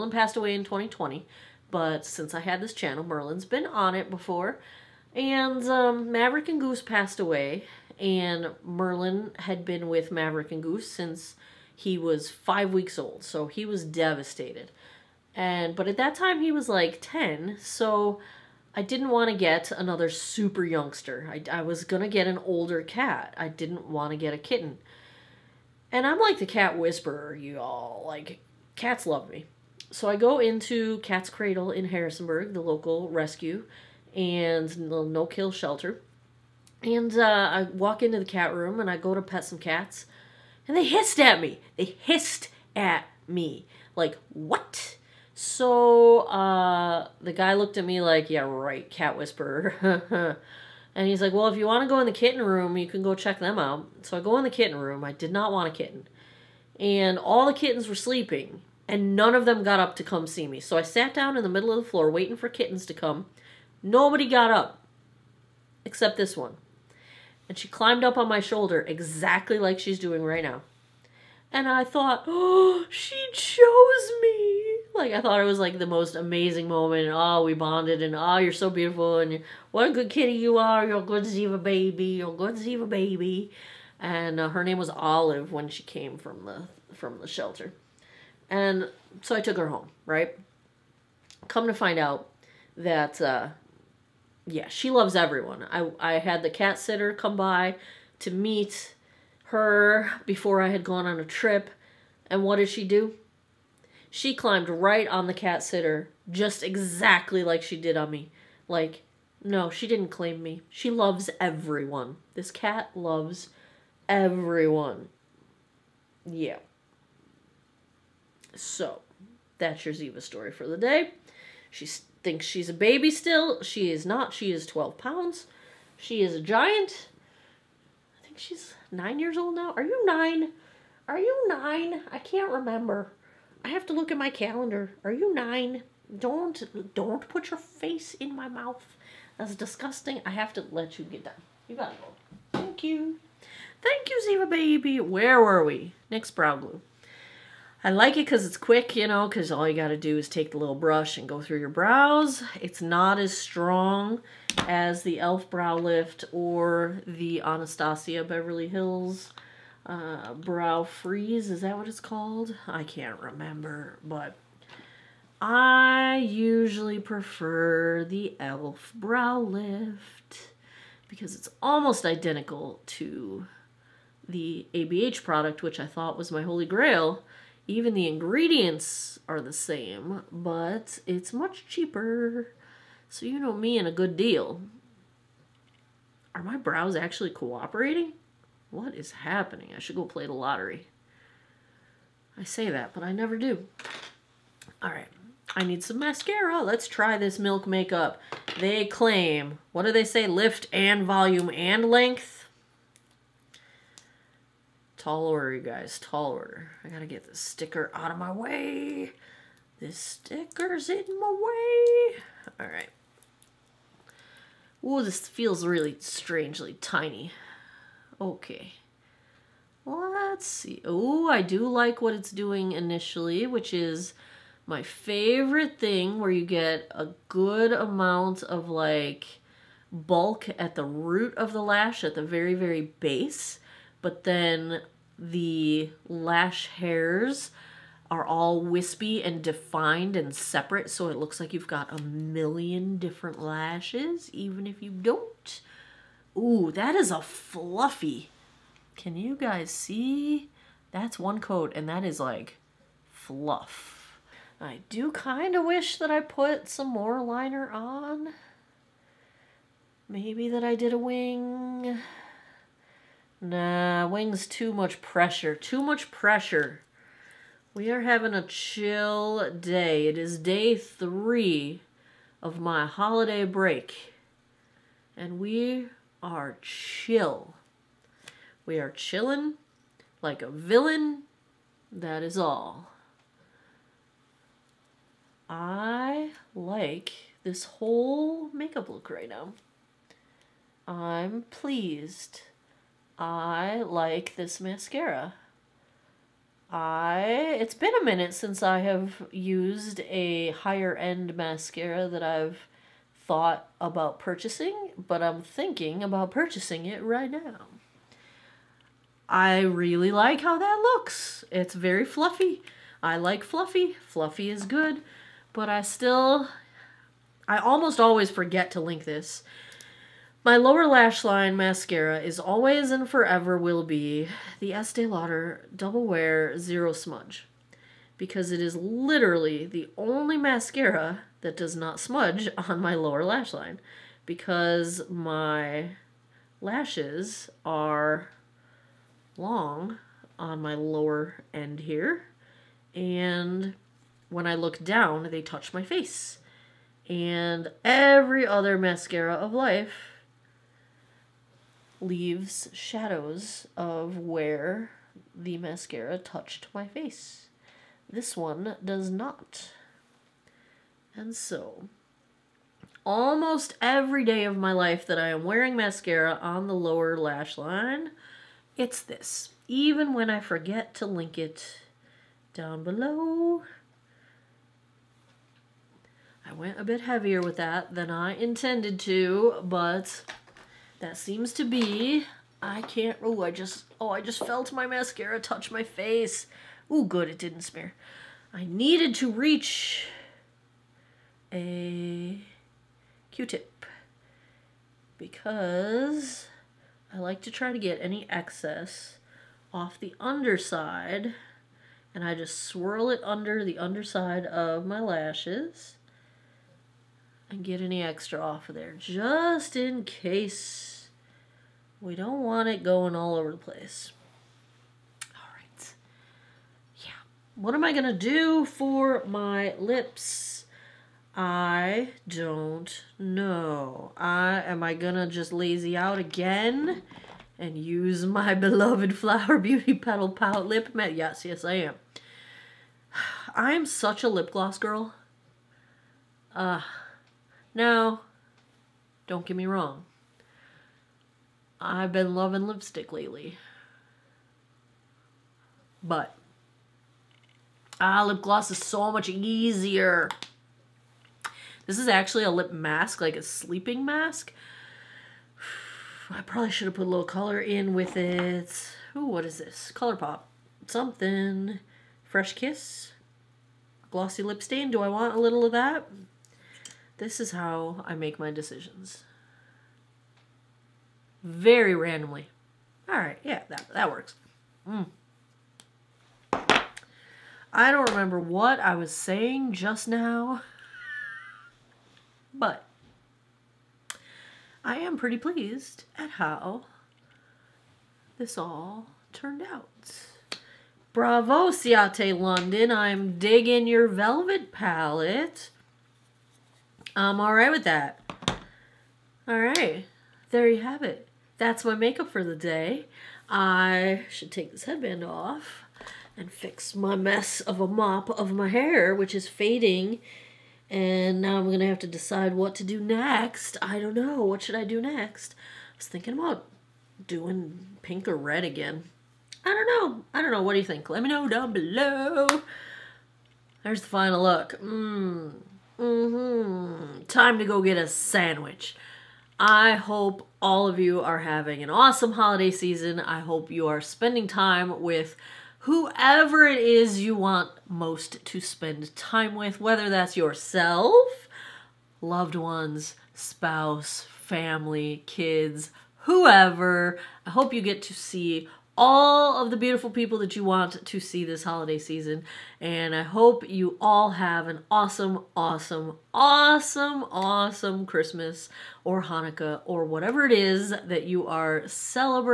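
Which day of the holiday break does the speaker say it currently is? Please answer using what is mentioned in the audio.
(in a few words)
Day 3.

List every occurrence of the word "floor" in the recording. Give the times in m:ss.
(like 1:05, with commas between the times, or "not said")
1:01.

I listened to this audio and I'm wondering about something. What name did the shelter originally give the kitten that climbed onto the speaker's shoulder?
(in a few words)
Olive.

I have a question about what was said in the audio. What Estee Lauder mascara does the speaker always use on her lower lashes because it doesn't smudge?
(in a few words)
Double Wear Zero Smudge.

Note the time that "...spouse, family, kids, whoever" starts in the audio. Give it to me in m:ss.
9:03.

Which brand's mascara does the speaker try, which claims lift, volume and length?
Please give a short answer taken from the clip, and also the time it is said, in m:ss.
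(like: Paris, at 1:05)
Milk Makeup, at 3:17.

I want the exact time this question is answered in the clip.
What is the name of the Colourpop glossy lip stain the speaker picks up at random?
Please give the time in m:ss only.
7:42.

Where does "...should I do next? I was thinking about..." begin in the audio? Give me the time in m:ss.
8:34.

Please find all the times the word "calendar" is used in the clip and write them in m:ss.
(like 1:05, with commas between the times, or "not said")
2:14.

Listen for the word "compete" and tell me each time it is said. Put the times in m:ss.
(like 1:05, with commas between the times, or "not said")
not said.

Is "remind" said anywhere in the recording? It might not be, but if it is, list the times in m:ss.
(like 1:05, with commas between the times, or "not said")
not said.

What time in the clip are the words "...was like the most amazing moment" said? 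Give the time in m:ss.
1:15.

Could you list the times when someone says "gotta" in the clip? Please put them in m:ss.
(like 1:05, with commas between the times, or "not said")
2:21, 3:26.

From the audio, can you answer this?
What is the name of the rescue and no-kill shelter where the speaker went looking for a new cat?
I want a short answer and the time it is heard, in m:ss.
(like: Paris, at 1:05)
Cat's Cradle, at 0:30.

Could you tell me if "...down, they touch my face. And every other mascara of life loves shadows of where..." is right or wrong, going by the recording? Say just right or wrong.
wrong.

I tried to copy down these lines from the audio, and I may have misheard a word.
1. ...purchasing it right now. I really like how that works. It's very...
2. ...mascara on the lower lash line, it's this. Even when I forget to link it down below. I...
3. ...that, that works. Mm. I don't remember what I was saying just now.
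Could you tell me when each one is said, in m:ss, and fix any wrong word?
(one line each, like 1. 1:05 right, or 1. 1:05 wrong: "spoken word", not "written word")
1. 5:06 wrong: "looks", not "works"
2. 6:05 right
3. 7:53 right.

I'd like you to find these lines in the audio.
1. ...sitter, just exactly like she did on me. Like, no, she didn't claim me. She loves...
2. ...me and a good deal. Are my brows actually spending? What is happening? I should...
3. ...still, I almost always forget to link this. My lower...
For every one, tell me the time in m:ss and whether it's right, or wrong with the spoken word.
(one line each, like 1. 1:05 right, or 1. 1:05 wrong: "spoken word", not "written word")
1. 1:45 right
2. 3:03 wrong: "cooperating", not "spending"
3. 5:15 right.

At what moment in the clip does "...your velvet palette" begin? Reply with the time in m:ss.
8:13.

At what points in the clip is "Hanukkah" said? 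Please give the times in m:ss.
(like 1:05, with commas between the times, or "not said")
9:19.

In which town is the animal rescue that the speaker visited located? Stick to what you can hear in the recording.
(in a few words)
Harrisonburg.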